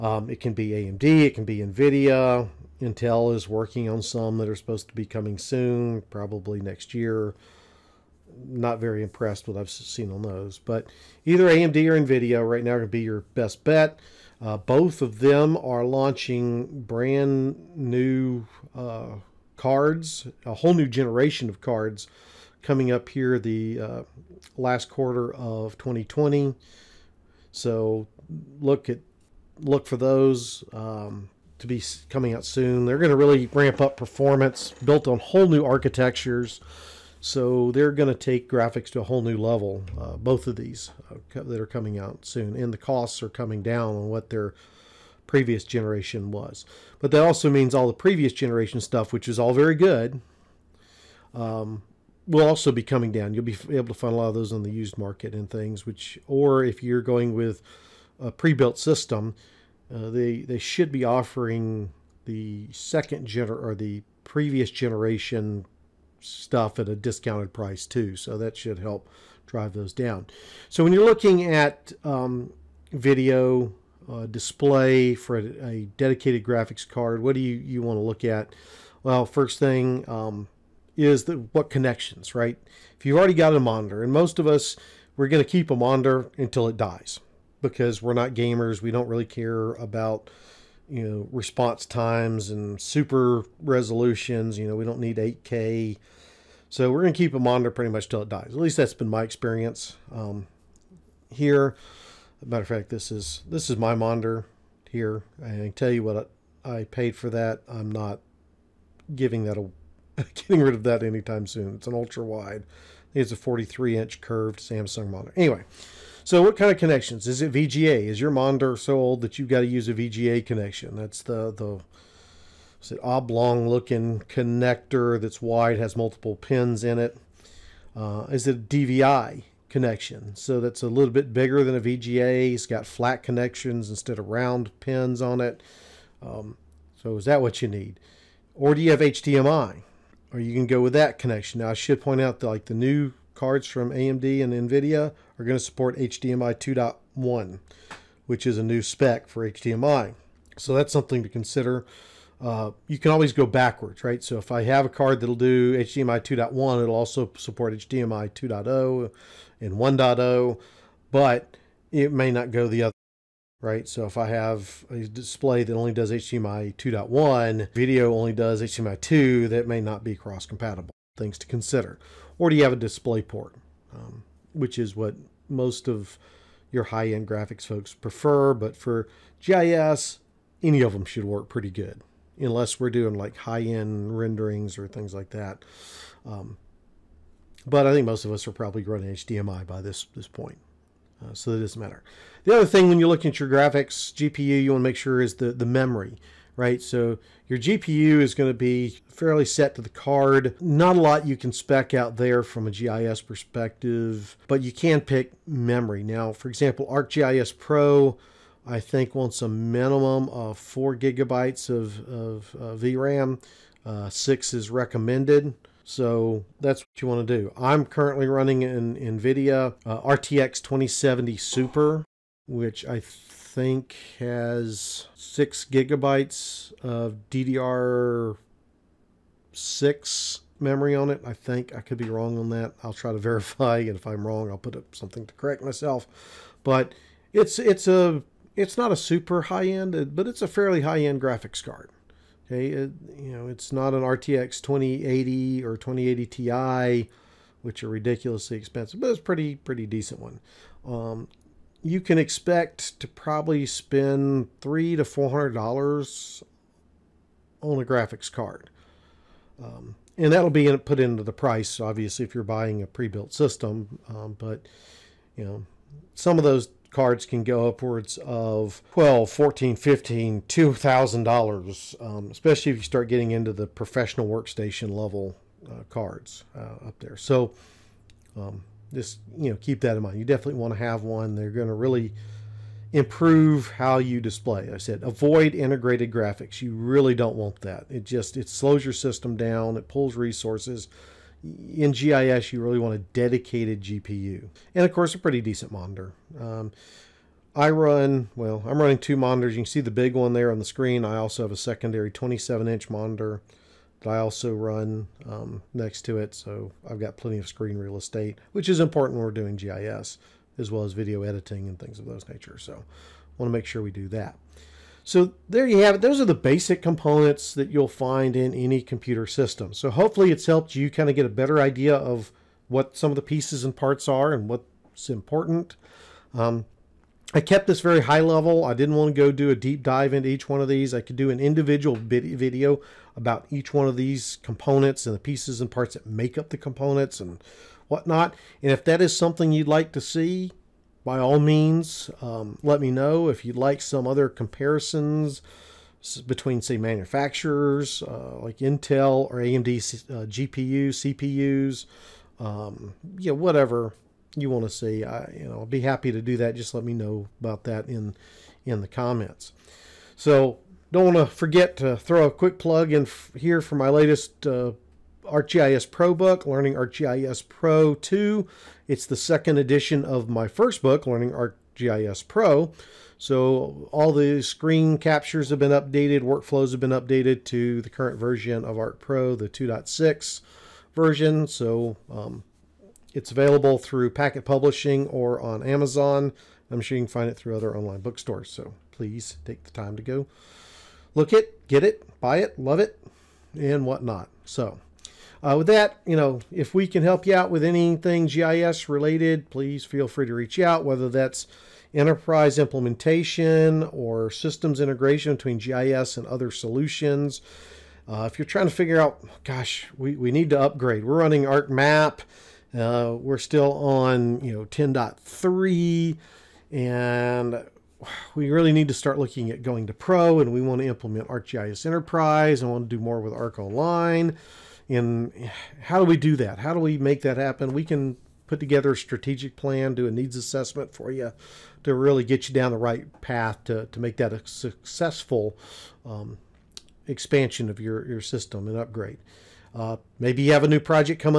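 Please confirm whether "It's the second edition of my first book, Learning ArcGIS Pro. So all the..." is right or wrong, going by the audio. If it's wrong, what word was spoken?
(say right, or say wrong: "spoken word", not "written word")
right.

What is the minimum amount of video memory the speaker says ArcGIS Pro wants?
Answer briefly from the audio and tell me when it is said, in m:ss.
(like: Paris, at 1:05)
4 gigabytes, at 3:30.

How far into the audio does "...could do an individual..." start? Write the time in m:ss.
5:31.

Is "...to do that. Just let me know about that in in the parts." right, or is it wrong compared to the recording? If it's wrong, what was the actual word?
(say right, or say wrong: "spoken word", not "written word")
wrong: "comments", not "parts".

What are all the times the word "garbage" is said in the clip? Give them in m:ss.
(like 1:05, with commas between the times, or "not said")
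not said.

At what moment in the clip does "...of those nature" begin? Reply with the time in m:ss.
5:11.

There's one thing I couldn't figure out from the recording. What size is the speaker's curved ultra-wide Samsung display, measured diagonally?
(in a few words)
43 inch.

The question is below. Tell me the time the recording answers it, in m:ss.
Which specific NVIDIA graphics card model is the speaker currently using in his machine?
3:40.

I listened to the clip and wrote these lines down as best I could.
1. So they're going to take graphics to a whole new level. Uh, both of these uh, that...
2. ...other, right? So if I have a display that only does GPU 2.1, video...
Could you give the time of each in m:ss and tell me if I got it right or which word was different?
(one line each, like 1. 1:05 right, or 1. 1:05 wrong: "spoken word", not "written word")
1. 0:37 right
2. 2:42 wrong: "HDMI", not "GPU".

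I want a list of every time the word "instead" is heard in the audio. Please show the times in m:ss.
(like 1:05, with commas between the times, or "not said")
2:13.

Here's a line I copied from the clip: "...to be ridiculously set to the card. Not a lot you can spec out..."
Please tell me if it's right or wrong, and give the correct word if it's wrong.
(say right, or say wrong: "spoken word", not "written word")
wrong: "fairly", not "ridiculously".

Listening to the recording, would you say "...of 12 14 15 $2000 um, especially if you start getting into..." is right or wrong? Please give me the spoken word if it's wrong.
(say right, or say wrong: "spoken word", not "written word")
right.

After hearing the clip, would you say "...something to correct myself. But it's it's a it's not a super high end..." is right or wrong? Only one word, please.
right.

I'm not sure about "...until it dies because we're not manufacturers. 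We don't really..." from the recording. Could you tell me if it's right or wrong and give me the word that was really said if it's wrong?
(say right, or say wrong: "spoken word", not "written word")
wrong: "gamers", not "manufacturers".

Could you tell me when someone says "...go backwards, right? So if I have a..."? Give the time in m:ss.
2:33.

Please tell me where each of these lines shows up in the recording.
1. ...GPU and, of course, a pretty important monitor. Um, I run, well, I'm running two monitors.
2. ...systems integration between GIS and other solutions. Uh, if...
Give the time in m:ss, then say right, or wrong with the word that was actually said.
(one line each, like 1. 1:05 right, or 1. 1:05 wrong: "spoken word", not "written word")
1. 4:53 wrong: "decent", not "important"
2. 6:44 right.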